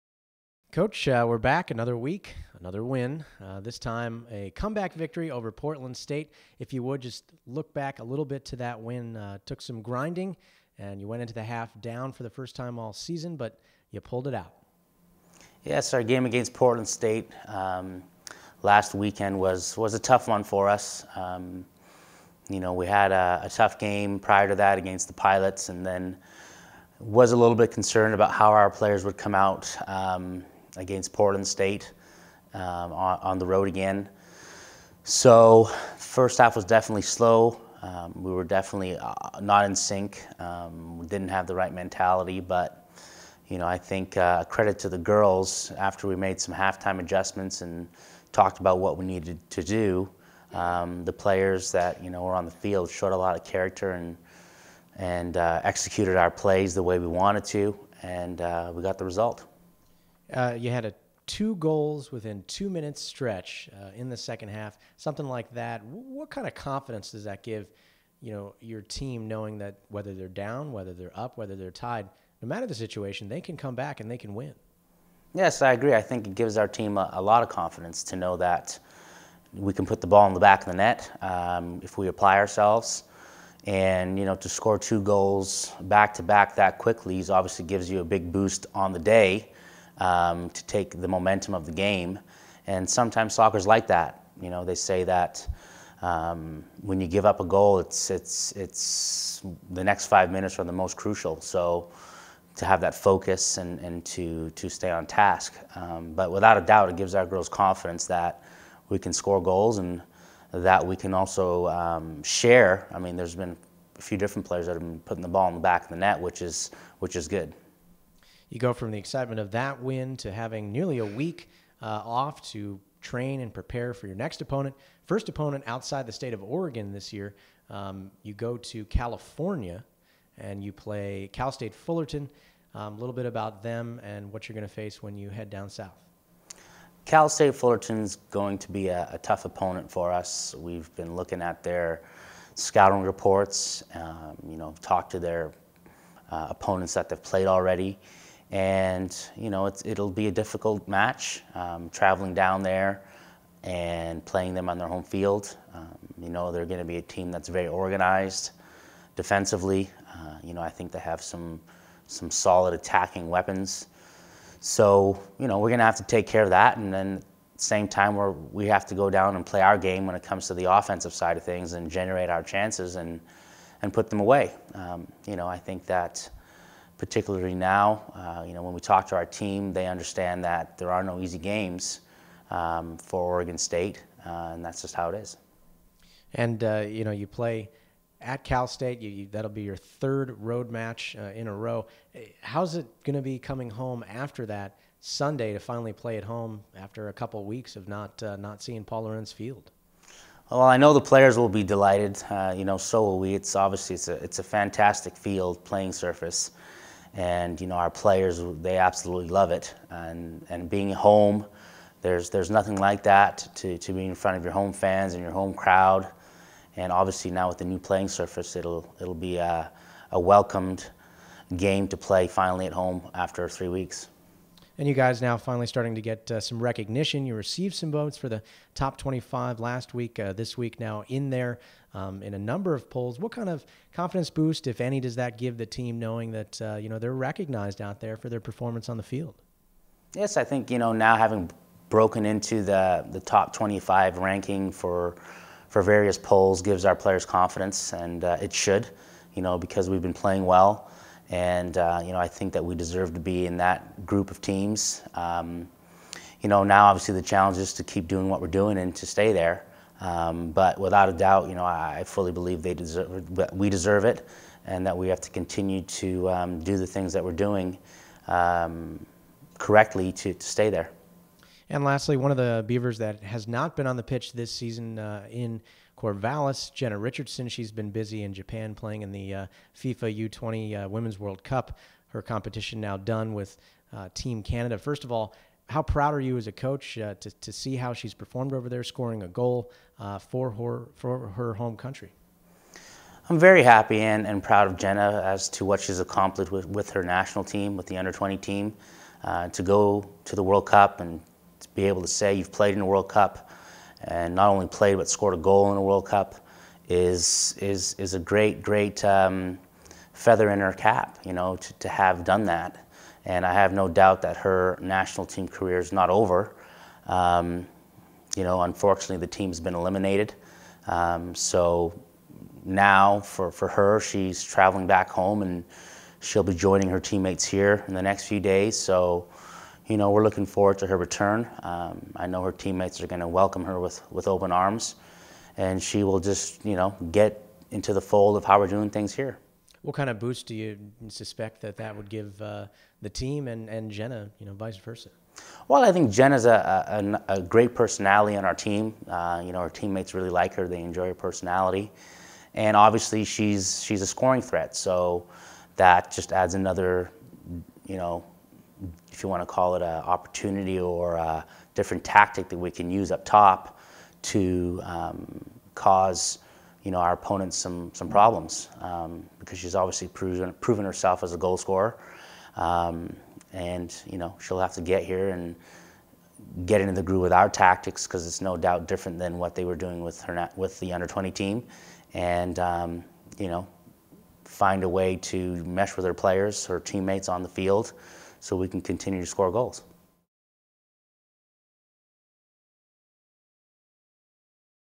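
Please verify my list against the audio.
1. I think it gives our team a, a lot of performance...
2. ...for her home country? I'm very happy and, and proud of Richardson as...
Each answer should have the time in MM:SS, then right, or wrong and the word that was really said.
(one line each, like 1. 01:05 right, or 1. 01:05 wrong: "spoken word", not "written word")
1. 01:15 wrong: "confidence", not "performance"
2. 04:50 wrong: "Jenna", not "Richardson".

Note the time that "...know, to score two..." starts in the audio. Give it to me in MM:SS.
01:24.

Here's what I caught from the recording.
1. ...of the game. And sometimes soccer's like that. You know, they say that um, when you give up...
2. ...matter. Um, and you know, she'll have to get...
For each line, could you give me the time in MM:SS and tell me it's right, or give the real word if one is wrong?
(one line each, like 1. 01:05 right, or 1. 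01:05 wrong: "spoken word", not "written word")
1. 01:31 right
2. 06:11 wrong: "scorer", not "matter".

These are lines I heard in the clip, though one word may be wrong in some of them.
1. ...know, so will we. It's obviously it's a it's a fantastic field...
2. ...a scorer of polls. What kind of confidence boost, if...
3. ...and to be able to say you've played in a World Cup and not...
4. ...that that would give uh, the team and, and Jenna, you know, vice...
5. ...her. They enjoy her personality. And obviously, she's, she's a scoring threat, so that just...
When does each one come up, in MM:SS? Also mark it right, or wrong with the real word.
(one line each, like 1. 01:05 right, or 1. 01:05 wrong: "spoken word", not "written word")
1. 03:22 right
2. 03:52 wrong: "number", not "scorer"
3. 05:00 right
4. 05:41 right
5. 05:50 right.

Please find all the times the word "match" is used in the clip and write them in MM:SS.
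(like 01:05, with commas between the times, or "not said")
02:30, 03:10.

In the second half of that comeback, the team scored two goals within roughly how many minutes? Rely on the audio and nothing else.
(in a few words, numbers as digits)
2.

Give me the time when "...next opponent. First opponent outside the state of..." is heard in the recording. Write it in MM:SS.
02:04.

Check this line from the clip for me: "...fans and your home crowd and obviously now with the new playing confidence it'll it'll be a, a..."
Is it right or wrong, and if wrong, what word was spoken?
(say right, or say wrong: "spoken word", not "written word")
wrong: "surface", not "confidence".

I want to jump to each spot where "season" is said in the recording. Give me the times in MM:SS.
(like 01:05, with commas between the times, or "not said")
00:12, 04:34.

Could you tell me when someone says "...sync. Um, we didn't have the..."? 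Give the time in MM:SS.
00:39.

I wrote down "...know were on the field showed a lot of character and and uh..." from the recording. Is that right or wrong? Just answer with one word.
right.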